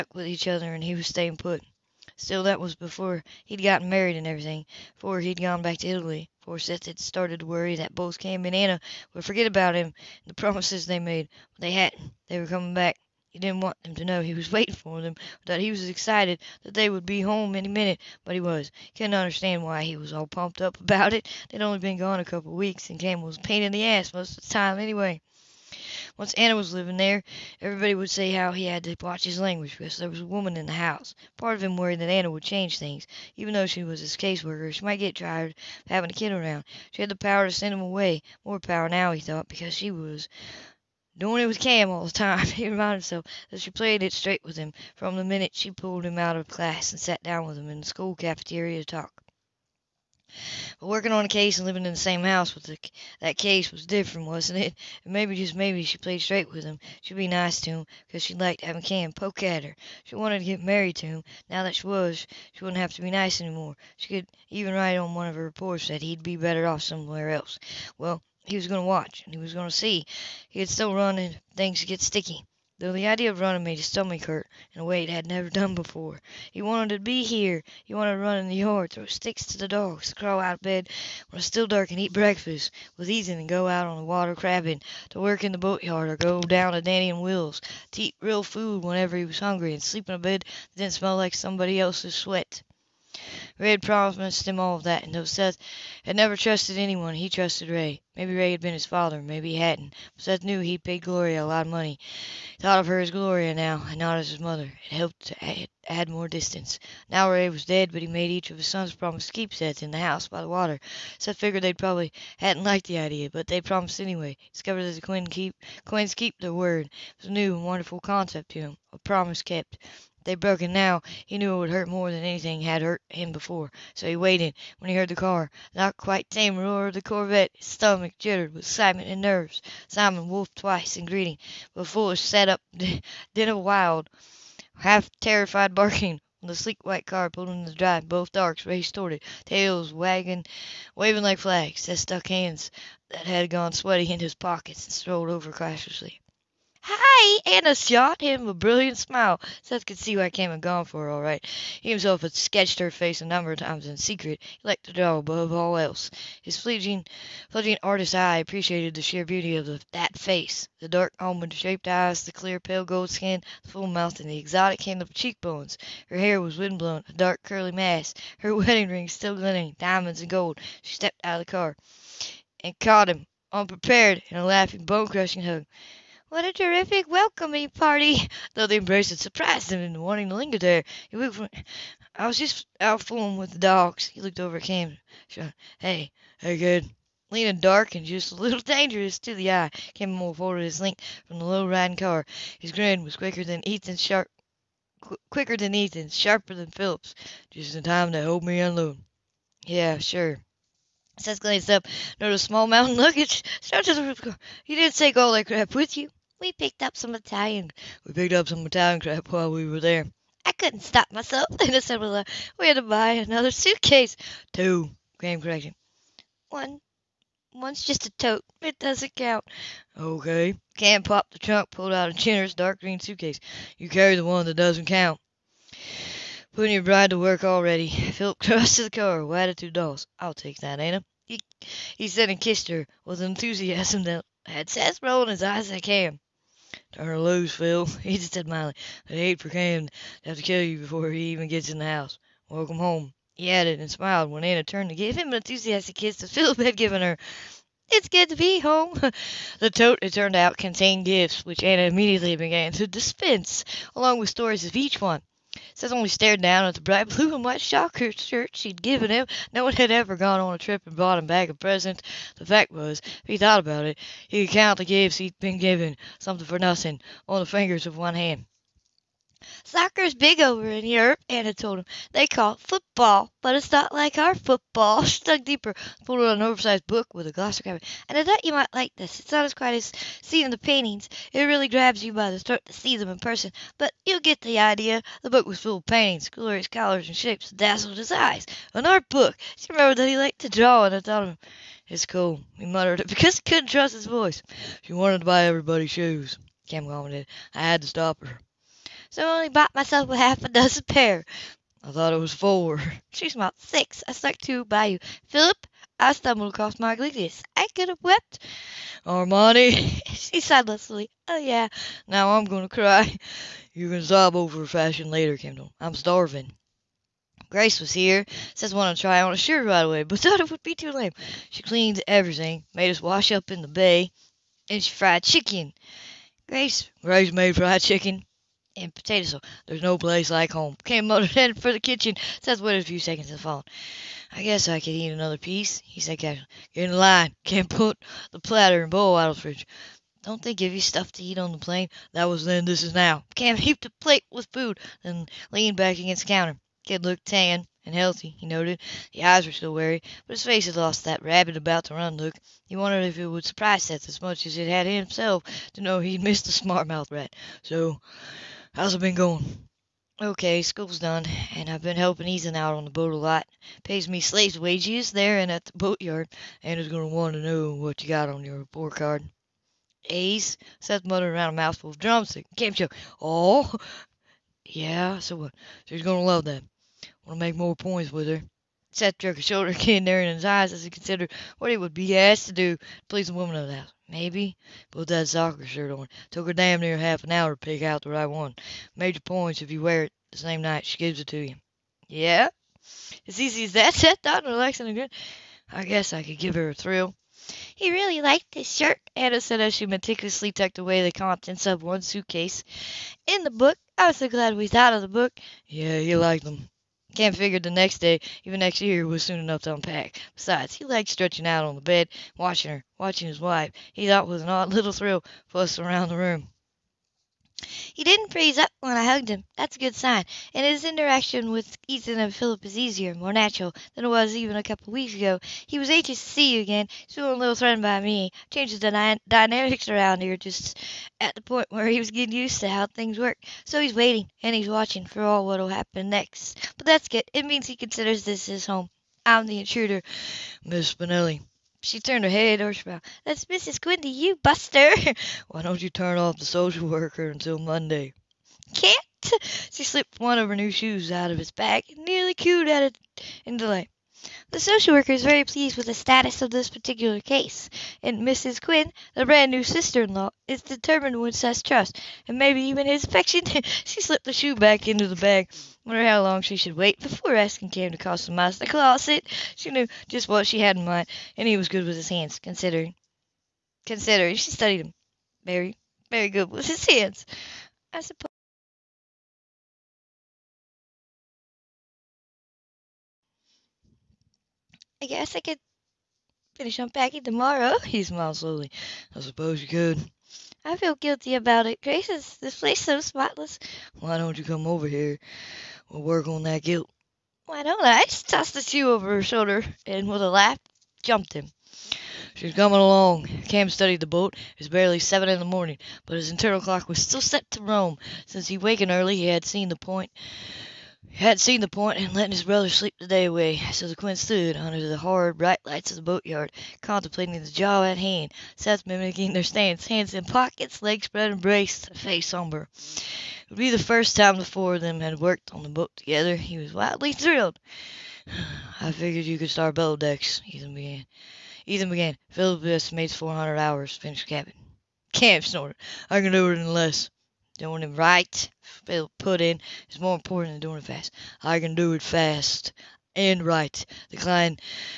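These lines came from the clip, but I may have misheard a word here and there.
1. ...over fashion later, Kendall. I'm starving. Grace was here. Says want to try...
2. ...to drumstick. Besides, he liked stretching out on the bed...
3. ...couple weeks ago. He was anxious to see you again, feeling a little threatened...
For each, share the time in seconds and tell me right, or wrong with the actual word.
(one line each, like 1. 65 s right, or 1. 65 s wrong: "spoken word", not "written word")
1. 314 s right
2. 409 s wrong: "unpack", not "drumstick"
3. 424 s right.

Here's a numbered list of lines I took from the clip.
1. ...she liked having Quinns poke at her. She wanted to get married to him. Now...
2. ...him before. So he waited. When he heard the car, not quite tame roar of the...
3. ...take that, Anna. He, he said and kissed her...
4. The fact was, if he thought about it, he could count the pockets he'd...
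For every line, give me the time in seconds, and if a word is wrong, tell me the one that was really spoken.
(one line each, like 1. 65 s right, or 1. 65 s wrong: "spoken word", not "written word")
1. 58 s wrong: "Cam", not "Quinns"
2. 123 s right
3. 230 s right
4. 262 s wrong: "gifts", not "pockets".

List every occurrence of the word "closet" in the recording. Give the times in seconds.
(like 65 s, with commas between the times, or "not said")
468 s.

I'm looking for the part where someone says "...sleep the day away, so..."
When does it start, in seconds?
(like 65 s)
512 s.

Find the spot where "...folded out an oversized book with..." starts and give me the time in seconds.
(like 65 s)
276 s.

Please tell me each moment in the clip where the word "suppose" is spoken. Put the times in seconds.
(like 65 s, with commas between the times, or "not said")
478 s, 489 s.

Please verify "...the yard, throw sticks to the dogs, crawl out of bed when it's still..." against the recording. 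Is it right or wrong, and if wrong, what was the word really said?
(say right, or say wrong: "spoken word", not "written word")
right.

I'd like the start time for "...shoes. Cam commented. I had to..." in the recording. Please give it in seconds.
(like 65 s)
295 s.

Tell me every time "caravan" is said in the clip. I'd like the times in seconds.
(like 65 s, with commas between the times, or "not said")
not said.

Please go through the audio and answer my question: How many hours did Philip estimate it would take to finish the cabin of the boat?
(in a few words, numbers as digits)
400.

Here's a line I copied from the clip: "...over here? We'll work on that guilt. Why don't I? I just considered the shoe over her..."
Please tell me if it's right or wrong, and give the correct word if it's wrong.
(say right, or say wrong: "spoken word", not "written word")
wrong: "tossed", not "considered".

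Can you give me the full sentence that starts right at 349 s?
The eyes were still wary, but his face had lost that rabbit about to run look.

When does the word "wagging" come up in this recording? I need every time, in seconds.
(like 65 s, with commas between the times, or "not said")
139 s.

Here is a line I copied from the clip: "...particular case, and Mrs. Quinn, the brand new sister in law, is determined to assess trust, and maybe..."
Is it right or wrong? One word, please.
right.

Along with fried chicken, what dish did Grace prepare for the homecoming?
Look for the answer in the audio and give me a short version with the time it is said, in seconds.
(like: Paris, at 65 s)
potato soup, at 328 s.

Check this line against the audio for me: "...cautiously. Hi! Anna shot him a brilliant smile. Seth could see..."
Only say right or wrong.
right.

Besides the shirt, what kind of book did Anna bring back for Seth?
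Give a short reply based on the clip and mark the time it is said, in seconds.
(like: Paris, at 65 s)
An art book, at 288 s.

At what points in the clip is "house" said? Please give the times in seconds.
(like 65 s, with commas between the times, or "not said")
30 s, 52 s, 109 s, 241 s, 383 s.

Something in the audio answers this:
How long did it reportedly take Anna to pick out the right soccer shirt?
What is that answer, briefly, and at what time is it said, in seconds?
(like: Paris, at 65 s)
half an hour, at 386 s.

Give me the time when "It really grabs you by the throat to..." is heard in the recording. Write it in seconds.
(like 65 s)
281 s.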